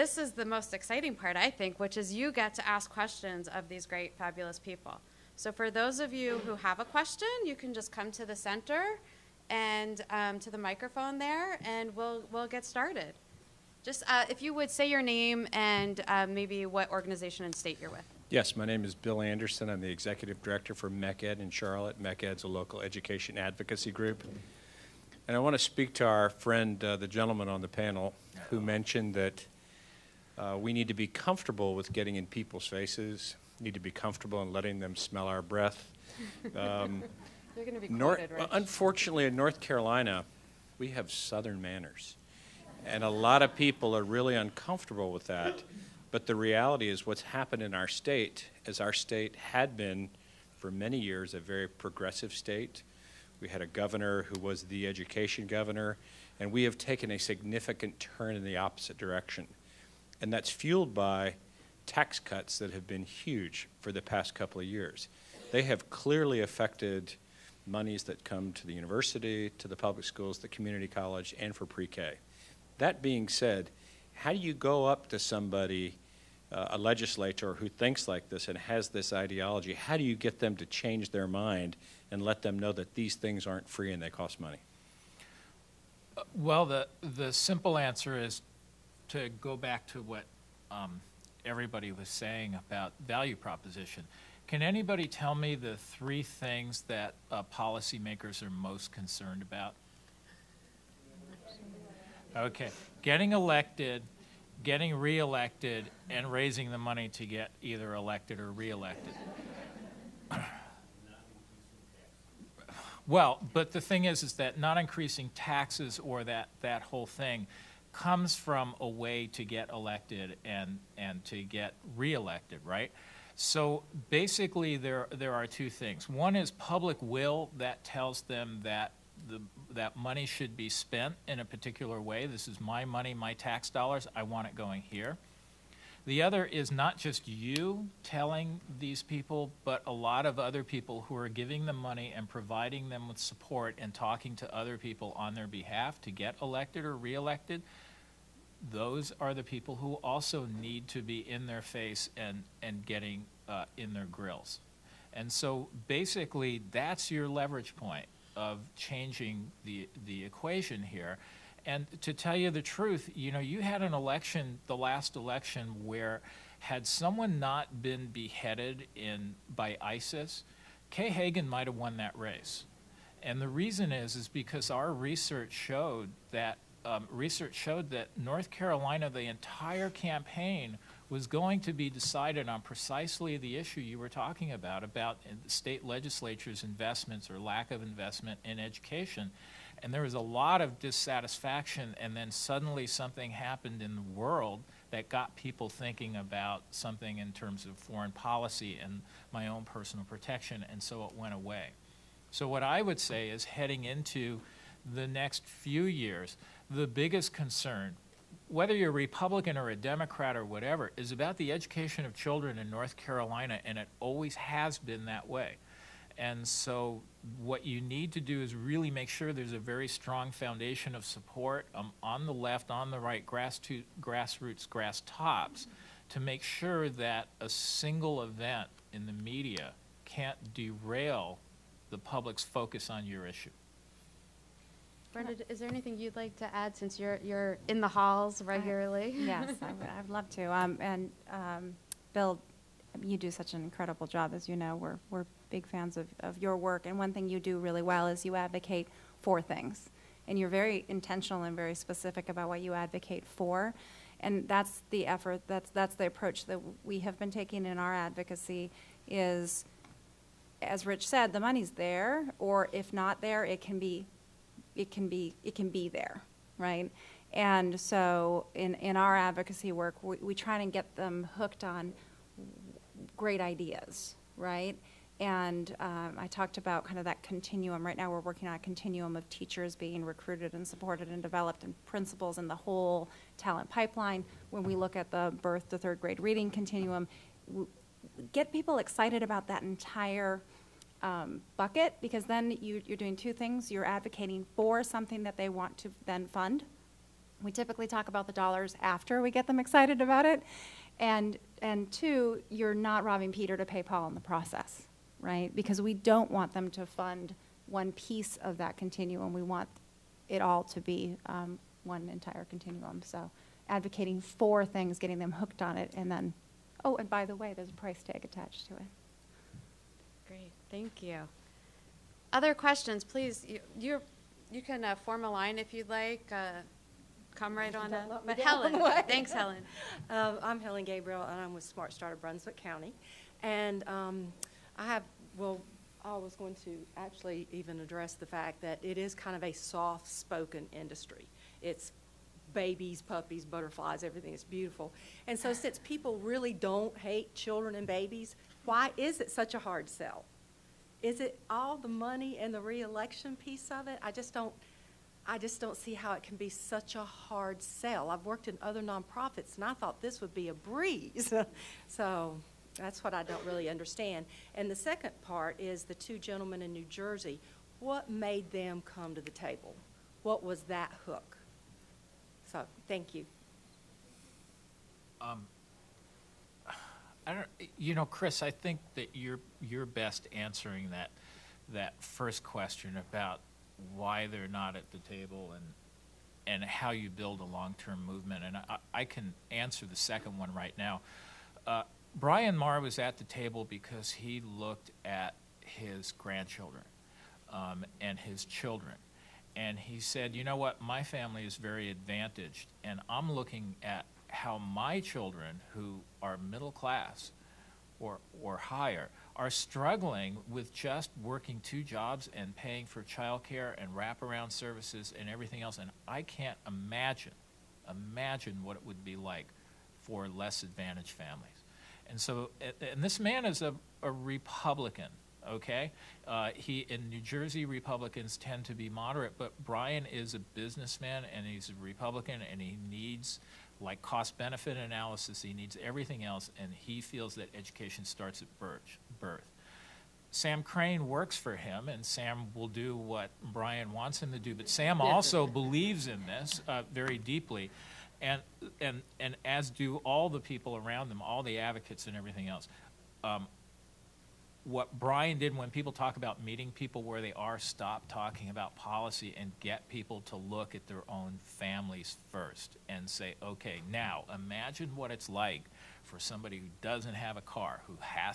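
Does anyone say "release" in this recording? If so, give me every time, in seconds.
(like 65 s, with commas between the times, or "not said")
not said.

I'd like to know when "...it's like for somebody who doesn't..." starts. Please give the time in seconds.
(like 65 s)
465 s.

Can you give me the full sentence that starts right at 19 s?
I'm the executive director for MeckEd in Charlotte.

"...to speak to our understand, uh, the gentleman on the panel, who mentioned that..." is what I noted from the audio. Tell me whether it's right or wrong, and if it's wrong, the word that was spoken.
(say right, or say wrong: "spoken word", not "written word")
wrong: "friend", not "understand".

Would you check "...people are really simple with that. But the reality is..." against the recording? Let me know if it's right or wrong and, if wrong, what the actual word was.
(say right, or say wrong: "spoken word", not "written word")
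wrong: "uncomfortable", not "simple".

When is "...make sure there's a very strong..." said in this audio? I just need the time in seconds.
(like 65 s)
218 s.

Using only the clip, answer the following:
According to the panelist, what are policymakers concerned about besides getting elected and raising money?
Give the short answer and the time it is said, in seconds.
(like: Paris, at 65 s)
getting reelected, at 104 s.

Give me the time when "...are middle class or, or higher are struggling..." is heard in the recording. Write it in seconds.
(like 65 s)
406 s.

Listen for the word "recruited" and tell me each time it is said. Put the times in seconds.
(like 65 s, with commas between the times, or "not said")
280 s.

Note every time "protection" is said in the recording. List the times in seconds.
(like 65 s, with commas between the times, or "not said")
200 s.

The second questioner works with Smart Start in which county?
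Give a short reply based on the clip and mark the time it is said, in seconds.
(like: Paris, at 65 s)
Brunswick County, at 332 s.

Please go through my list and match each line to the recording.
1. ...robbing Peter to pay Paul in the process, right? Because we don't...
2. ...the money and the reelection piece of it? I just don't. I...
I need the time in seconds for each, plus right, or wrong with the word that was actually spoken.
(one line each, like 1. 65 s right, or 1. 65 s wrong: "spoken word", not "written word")
1. 303 s right
2. 351 s right.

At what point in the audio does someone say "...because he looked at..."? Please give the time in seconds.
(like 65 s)
393 s.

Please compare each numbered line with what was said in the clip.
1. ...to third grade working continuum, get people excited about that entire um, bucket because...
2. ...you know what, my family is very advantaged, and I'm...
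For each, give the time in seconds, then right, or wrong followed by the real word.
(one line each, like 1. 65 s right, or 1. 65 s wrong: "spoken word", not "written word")
1. 285 s wrong: "reading", not "working"
2. 400 s right.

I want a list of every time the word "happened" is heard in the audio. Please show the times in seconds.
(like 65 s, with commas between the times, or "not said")
47 s, 193 s.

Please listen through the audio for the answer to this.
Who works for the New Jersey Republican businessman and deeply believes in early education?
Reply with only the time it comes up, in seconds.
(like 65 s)
440 s.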